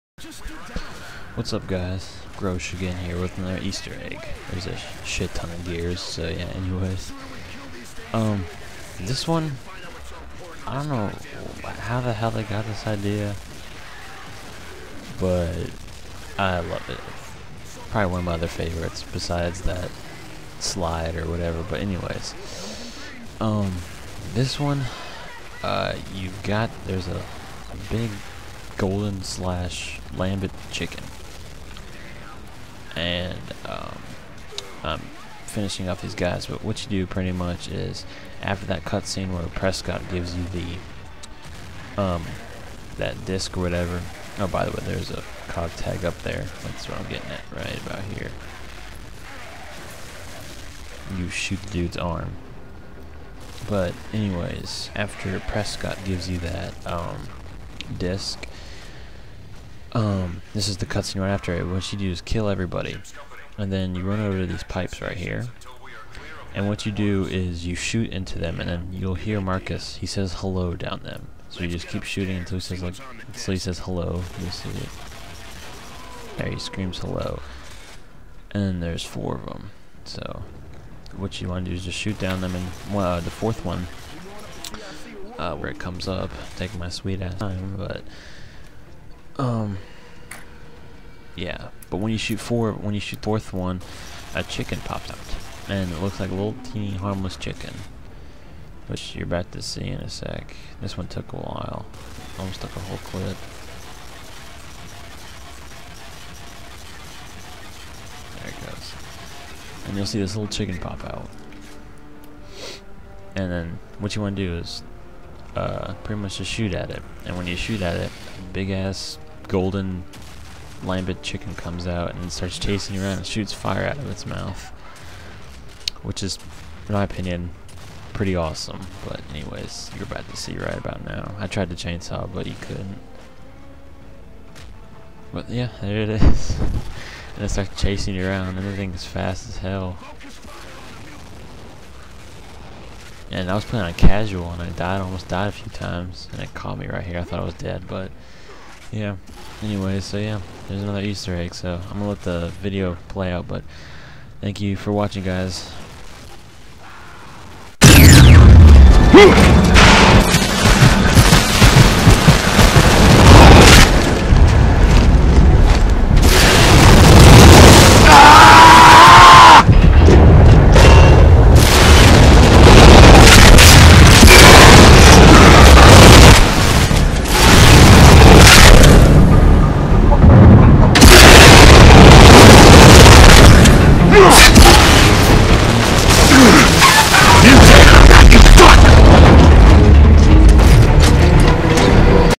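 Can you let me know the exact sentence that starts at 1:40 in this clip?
This one took a while, almost took a whole clip.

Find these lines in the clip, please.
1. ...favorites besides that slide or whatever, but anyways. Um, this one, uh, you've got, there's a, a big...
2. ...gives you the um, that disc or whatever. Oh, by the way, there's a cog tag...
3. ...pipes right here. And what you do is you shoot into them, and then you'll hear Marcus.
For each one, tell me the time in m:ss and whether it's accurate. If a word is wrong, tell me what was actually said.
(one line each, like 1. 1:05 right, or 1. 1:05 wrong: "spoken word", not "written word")
1. 0:18 right
2. 0:40 right
3. 1:04 right.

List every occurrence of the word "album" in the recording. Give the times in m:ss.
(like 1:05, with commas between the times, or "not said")
not said.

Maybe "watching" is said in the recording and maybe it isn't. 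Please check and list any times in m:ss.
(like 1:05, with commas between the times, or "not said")
2:34.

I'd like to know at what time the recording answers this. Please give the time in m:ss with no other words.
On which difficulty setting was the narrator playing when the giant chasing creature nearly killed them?
2:23.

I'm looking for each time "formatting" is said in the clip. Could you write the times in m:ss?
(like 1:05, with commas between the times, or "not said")
not said.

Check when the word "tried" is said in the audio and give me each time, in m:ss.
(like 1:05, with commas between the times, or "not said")
2:11.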